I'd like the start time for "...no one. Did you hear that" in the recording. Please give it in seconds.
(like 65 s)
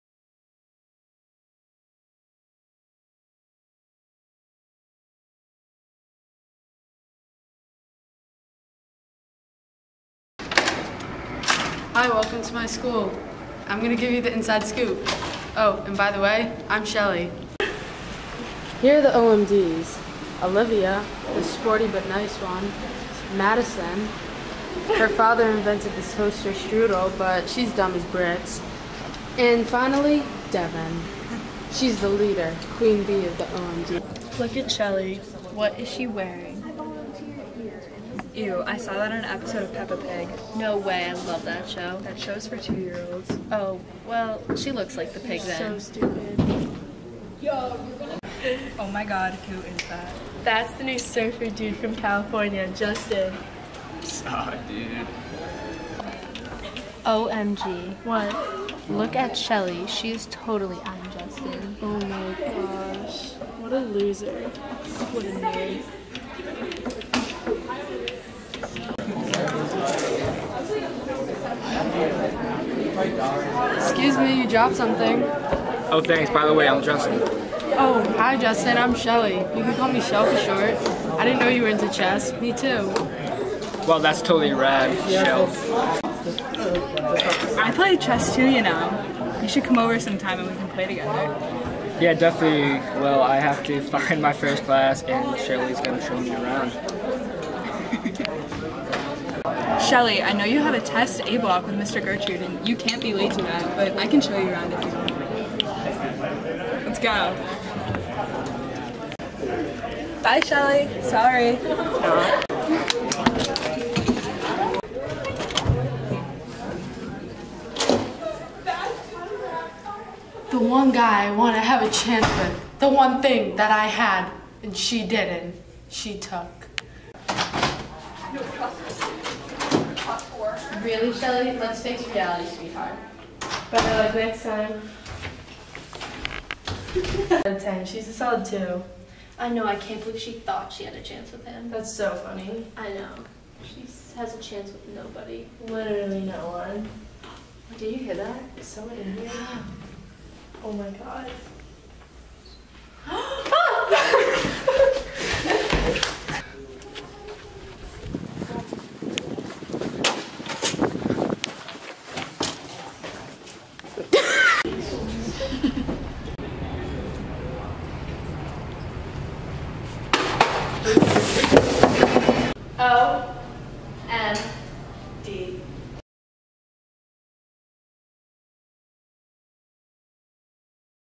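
146 s.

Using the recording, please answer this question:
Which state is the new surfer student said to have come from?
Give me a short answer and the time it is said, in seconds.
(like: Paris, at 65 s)
California, at 51 s.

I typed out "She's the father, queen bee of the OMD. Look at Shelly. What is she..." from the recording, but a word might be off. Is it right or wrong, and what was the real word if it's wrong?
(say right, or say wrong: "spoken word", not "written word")
wrong: "leader", not "father".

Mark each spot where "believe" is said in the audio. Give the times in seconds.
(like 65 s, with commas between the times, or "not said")
140 s.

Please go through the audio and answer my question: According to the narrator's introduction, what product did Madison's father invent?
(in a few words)
Toaster strudel.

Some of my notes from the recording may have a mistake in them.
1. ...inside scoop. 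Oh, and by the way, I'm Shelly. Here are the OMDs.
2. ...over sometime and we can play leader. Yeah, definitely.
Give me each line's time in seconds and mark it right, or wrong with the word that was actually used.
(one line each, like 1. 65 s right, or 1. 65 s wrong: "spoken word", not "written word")
1. 14 s right
2. 89 s wrong: "together", not "leader".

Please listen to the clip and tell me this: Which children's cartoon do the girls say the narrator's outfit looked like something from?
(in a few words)
Peppa Pig.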